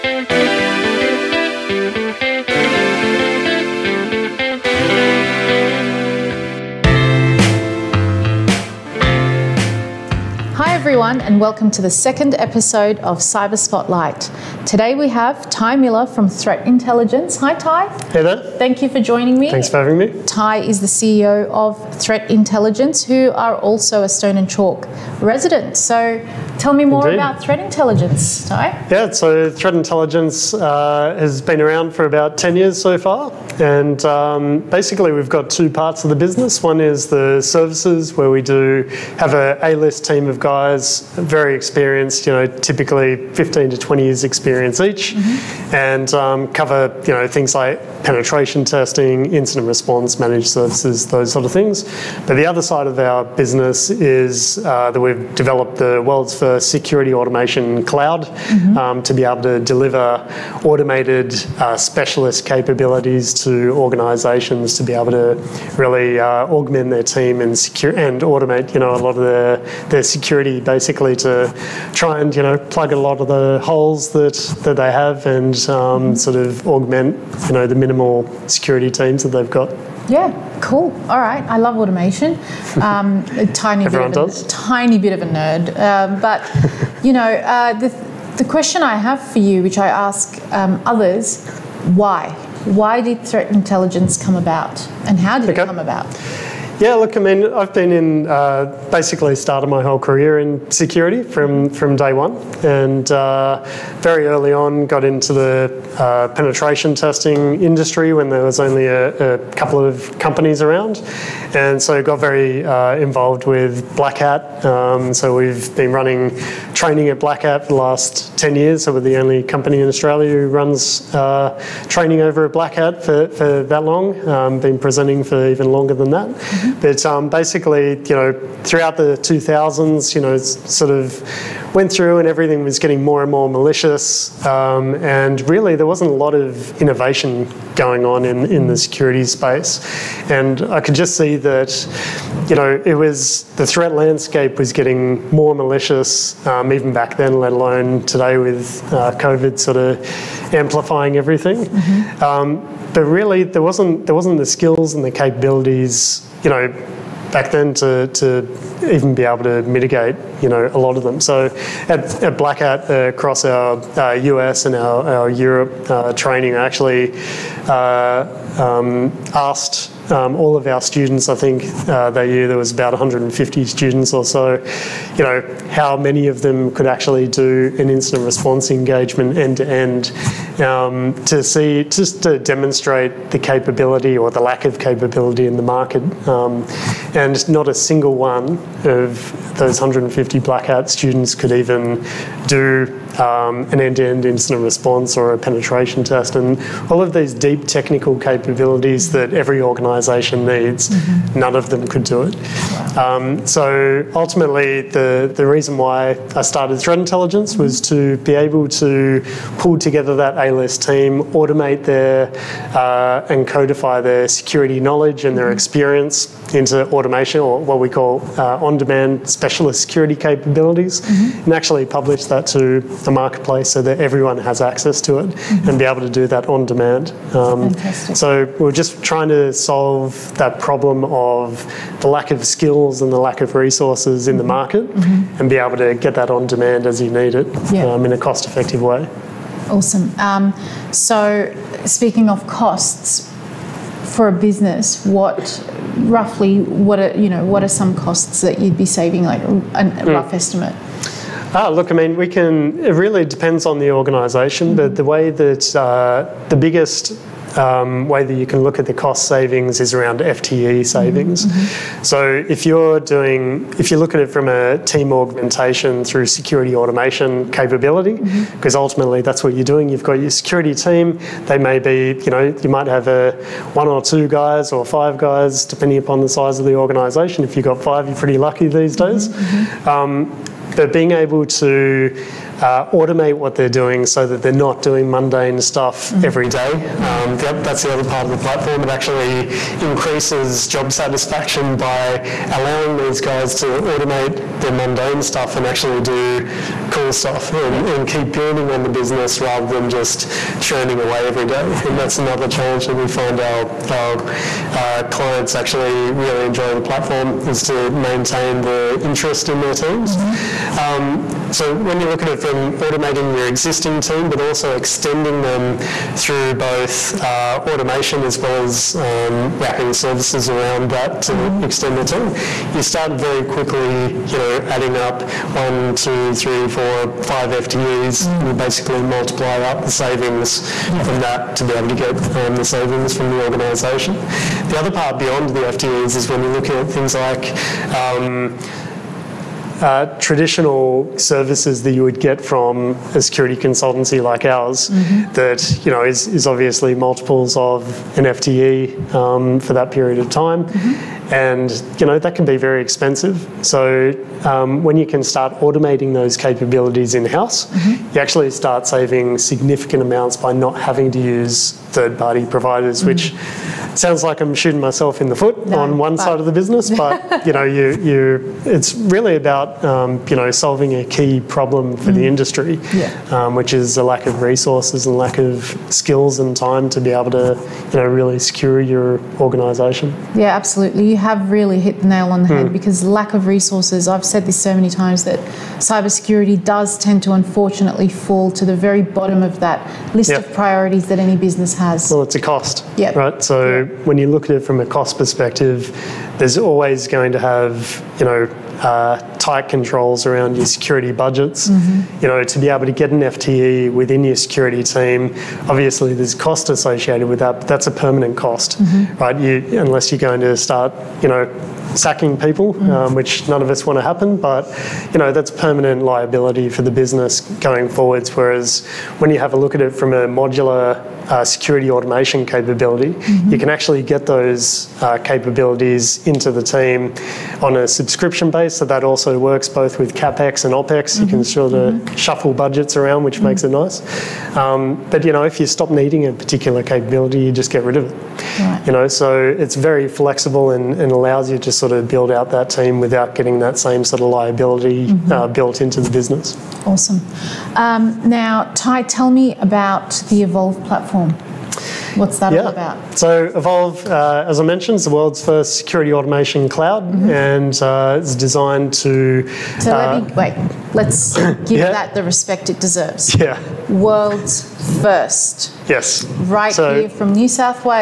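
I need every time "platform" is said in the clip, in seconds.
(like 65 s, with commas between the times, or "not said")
288 s, 306 s, 450 s.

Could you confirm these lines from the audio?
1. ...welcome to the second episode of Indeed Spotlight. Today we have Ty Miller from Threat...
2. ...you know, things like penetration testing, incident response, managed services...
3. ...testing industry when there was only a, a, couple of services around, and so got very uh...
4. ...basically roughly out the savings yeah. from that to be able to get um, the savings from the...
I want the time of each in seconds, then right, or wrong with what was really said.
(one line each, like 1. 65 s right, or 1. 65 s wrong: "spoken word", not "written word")
1. 11 s wrong: "Cyber", not "Indeed"
2. 47 s right
3. 106 s wrong: "companies", not "services"
4. 328 s wrong: "multiply", not "roughly".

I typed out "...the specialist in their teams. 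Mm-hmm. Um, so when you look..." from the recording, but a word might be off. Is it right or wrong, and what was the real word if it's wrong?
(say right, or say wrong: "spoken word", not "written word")
wrong: "interest", not "specialist".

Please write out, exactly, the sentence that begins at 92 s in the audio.
Why did threat intelligence come about, and how did okay.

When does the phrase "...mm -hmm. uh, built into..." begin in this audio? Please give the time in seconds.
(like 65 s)
445 s.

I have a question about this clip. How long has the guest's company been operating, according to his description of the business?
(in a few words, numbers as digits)
10 years.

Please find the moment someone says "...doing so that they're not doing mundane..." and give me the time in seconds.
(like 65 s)
283 s.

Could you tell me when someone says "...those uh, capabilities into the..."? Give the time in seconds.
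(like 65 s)
424 s.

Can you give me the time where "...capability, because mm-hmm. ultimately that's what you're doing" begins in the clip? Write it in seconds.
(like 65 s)
267 s.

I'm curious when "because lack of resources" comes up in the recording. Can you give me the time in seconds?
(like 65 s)
382 s.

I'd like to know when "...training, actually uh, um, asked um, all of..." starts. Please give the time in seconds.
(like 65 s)
166 s.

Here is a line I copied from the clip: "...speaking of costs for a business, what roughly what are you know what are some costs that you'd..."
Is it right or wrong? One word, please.
right.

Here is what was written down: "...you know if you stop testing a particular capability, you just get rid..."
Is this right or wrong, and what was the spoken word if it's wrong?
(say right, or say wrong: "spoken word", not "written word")
wrong: "needing", not "testing".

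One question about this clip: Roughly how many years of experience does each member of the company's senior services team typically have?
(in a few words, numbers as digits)
15 to 20 years.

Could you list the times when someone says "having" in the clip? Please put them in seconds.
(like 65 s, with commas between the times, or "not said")
19 s, 360 s.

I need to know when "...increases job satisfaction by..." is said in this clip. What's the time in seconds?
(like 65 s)
289 s.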